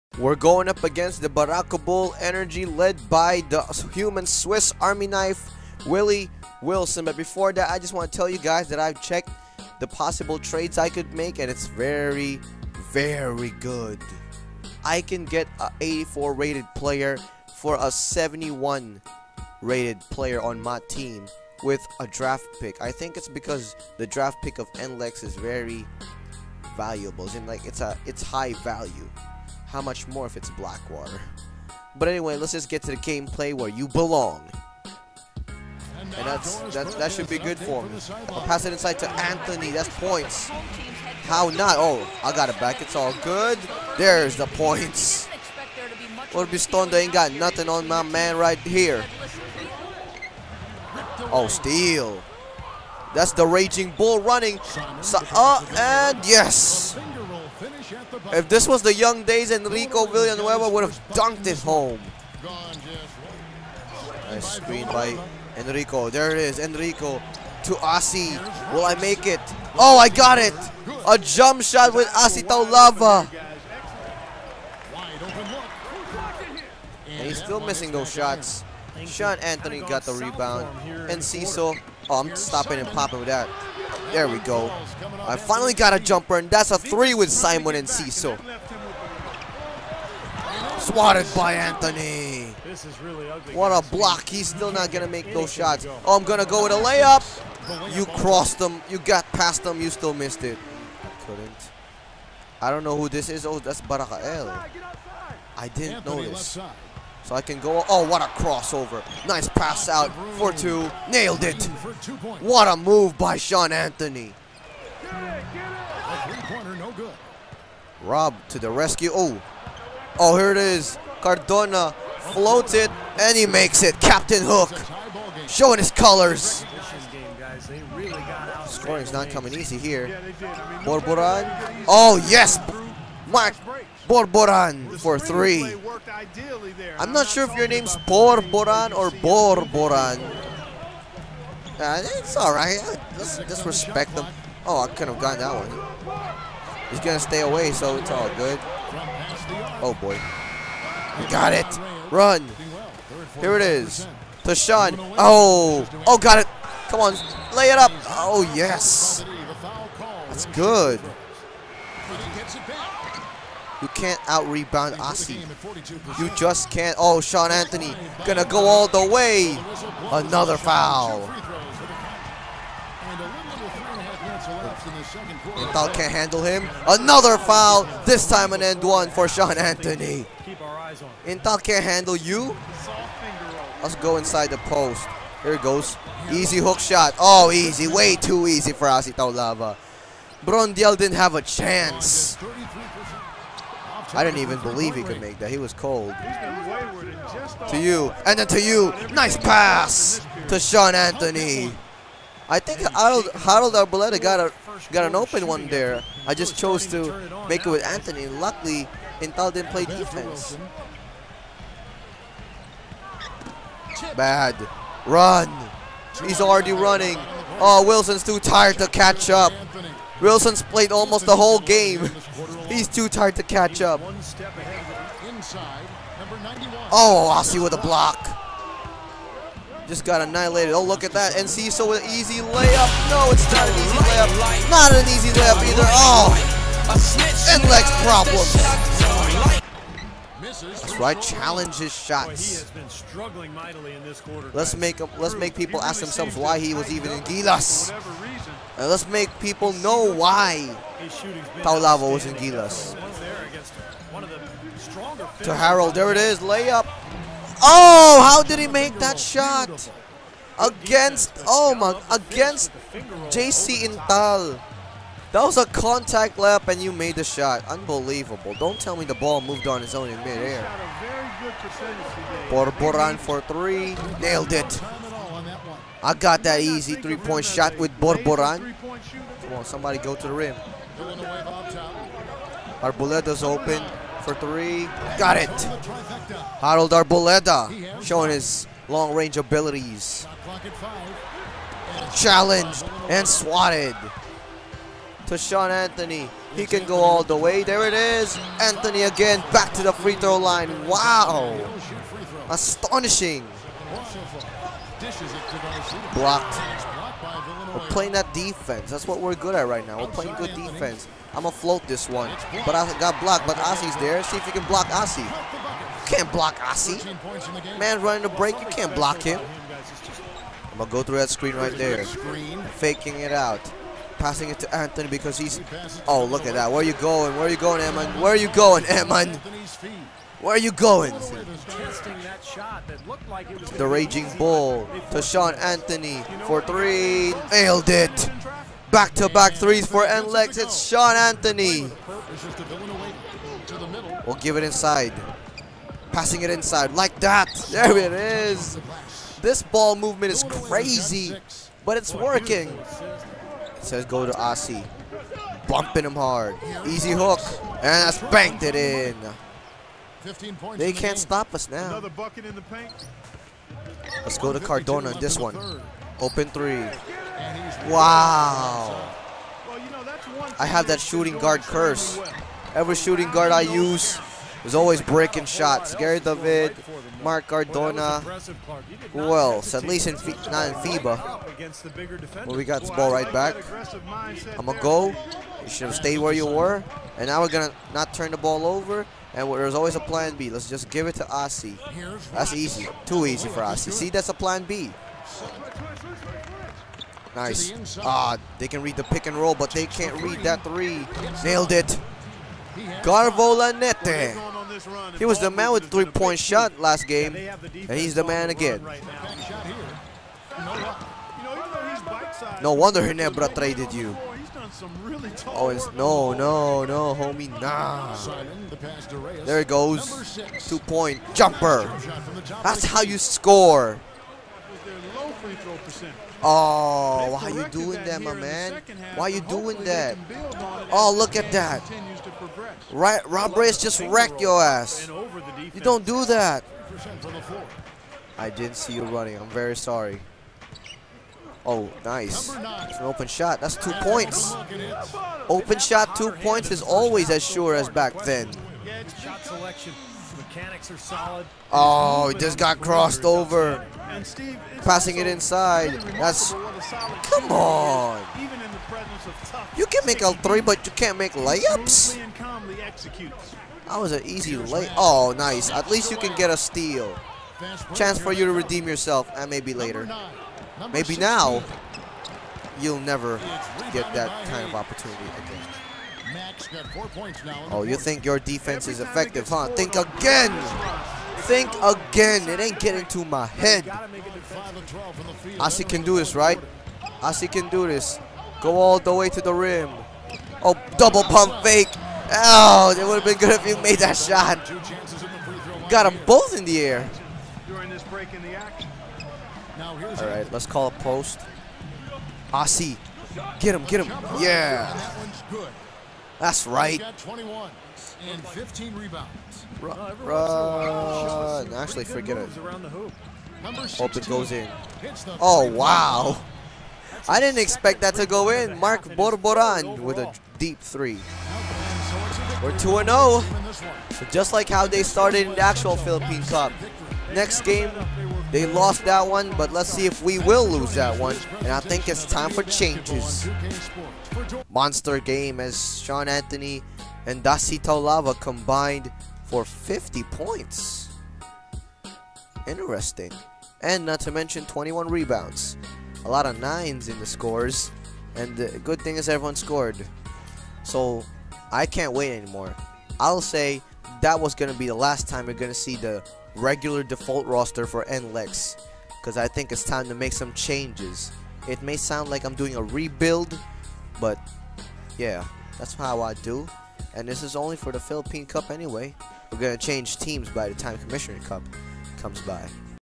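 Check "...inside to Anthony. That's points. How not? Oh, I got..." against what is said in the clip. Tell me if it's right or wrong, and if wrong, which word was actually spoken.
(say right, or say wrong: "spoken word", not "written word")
right.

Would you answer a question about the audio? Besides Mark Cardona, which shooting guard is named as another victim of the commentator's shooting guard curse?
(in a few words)
Gary David.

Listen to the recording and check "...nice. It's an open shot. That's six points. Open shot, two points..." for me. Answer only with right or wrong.
wrong.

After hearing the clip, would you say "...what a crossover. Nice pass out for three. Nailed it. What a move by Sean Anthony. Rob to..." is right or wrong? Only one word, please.
wrong.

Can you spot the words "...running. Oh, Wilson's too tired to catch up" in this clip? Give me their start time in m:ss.
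3:36.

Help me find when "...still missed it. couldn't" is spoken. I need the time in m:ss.
1:39.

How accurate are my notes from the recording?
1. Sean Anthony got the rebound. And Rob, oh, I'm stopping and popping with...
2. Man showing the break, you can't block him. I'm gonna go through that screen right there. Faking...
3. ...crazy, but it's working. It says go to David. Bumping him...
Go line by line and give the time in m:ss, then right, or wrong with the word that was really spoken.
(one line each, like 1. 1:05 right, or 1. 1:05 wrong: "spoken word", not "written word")
1. 1:19 wrong: "Cecil", not "Rob"
2. 5:17 wrong: "running", not "showing"
3. 5:50 wrong: "Asi", not "David".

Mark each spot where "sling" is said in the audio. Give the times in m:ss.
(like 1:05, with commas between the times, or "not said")
not said.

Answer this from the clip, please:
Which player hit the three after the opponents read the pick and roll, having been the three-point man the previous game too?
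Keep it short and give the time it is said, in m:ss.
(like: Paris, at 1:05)
Garvola Lanete, at 6:43.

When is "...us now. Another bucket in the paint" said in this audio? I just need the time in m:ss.
6:01.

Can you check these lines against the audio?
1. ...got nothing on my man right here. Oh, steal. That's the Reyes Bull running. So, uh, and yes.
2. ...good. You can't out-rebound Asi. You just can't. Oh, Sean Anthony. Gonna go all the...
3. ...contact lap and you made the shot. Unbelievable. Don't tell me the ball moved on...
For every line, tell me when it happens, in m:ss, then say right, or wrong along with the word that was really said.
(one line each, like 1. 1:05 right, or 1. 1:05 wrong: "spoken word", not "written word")
1. 0:47 wrong: "Raging", not "Reyes"
2. 2:40 right
3. 4:25 right.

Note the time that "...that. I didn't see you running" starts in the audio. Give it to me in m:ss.
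7:16.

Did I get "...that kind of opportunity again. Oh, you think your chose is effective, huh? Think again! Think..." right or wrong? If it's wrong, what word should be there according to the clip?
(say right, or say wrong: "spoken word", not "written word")
wrong: "defense", not "chose".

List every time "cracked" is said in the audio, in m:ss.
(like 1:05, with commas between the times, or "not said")
not said.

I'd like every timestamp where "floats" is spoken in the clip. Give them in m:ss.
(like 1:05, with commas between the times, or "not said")
2:02, 5:11.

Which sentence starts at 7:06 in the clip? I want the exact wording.
Oh, why are you doing that, my man?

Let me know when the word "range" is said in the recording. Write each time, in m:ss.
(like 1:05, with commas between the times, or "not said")
4:49.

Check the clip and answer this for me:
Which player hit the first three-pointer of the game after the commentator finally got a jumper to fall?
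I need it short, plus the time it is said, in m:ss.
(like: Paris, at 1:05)
Simon Enciso, at 1:27.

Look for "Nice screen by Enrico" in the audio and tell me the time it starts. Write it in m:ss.
1:04.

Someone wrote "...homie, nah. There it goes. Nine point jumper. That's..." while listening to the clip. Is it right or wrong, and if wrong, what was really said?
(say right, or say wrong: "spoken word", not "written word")
wrong: "Two", not "Nine".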